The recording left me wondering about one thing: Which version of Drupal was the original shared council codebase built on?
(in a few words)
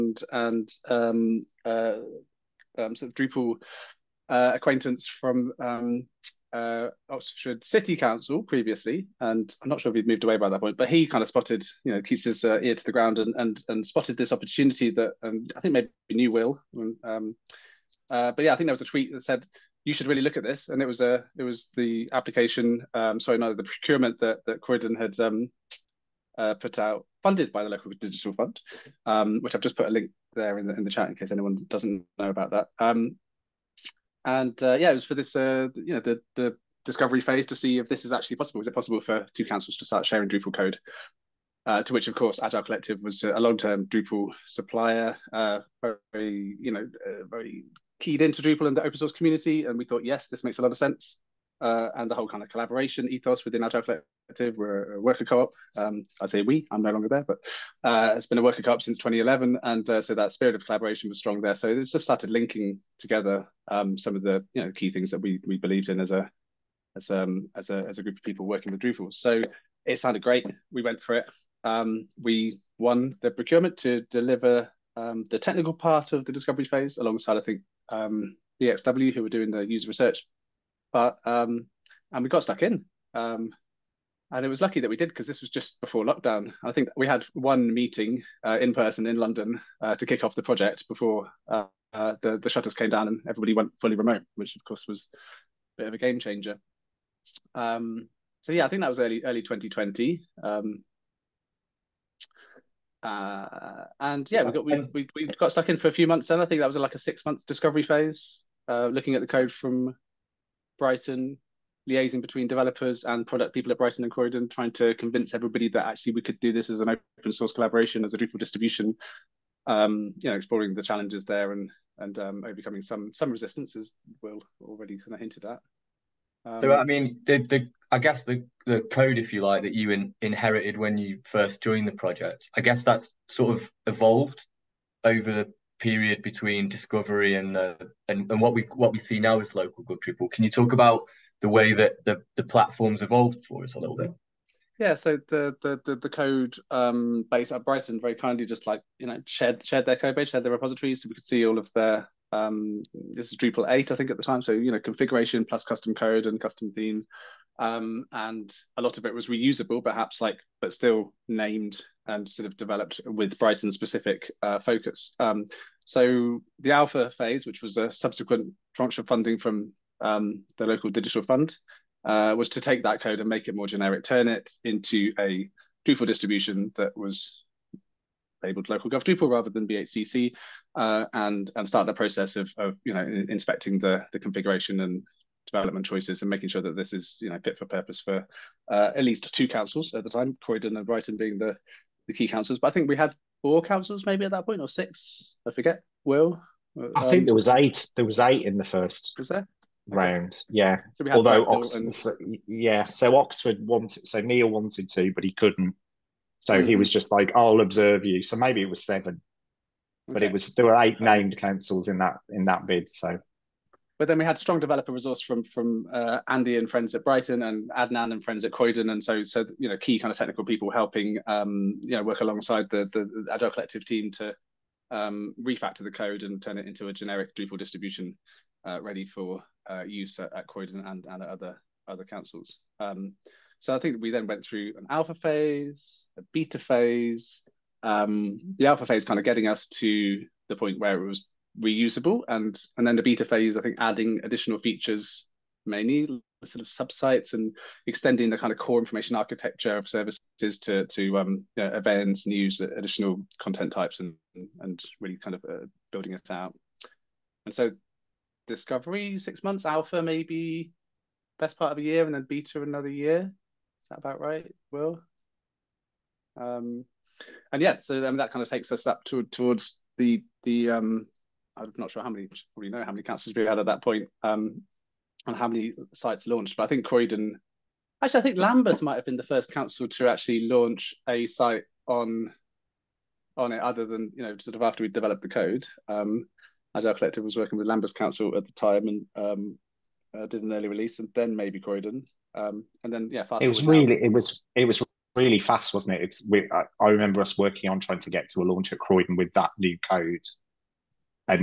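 Drupal 8.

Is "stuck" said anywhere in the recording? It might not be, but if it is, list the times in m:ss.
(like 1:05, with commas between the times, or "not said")
1:22, 1:45.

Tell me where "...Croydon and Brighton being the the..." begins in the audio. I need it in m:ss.
3:10.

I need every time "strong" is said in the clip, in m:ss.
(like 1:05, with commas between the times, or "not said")
1:01, 3:34.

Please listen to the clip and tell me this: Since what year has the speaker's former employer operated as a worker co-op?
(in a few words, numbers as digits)
2011.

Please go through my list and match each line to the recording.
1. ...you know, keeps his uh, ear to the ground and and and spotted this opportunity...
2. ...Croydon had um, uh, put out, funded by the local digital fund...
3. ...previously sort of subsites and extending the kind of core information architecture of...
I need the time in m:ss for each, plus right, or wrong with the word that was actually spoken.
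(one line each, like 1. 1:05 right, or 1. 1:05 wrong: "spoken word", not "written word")
1. 0:11 right
2. 0:24 right
3. 4:05 wrong: "mainly", not "previously".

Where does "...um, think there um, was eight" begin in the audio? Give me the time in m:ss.
3:17.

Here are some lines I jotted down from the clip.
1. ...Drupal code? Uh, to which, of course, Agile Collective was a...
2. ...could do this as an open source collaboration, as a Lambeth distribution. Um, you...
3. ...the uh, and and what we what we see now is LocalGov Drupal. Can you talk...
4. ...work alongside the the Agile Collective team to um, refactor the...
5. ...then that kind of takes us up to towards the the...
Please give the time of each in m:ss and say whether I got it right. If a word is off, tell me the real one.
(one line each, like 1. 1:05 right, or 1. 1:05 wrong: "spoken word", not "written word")
1. 0:40 right
2. 1:56 wrong: "Drupal", not "Lambeth"
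3. 2:17 right
4. 3:42 right
5. 4:27 right.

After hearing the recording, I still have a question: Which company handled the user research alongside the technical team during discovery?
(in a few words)
XW.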